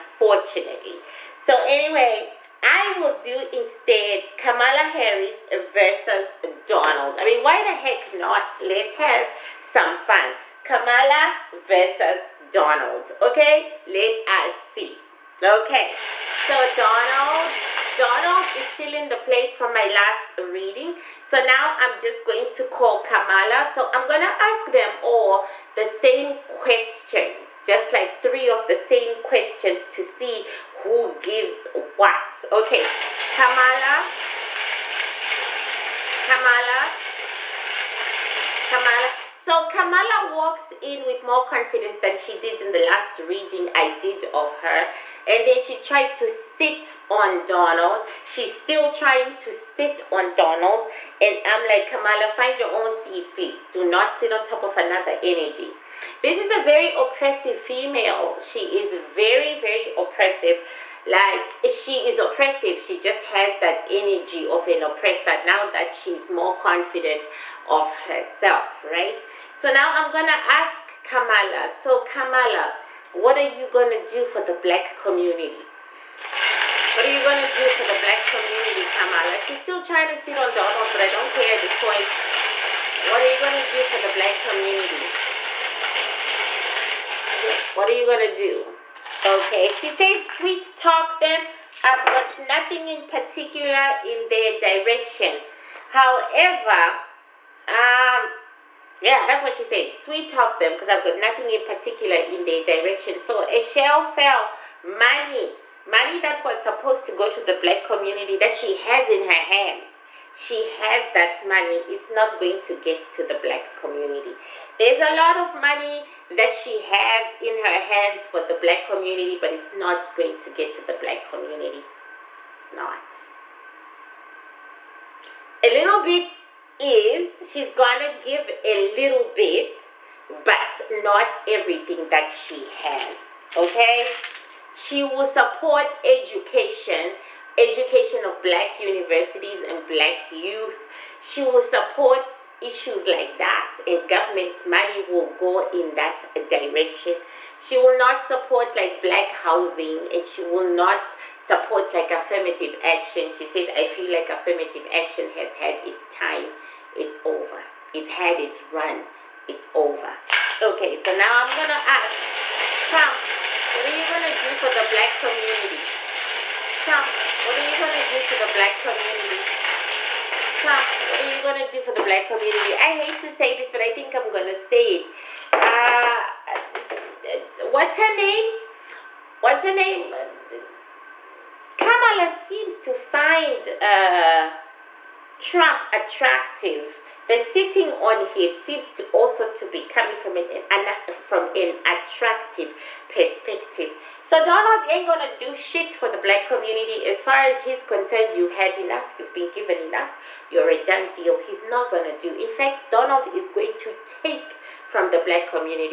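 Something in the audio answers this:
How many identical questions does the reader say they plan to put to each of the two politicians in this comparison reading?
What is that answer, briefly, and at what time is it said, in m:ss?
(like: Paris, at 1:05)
3, at 0:28.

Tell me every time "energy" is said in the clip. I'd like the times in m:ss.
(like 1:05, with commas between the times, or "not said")
0:55, 1:03.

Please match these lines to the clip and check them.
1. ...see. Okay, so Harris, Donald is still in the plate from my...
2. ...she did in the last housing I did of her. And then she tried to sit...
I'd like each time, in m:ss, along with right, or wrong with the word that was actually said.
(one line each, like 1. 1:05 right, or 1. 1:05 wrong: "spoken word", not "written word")
1. 0:14 wrong: "Donald", not "Harris"
2. 0:42 wrong: "reading", not "housing".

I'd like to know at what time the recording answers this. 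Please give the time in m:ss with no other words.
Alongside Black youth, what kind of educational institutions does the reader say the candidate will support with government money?
2:18.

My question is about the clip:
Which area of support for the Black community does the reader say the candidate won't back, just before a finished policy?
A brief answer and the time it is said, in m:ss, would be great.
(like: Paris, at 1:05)
Black housing, at 2:29.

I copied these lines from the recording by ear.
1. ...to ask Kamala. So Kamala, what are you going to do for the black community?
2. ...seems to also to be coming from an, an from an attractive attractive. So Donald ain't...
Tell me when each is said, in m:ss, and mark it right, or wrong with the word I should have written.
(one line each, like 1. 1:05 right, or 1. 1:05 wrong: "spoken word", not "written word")
1. 1:10 right
2. 3:08 wrong: "perspective", not "attractive".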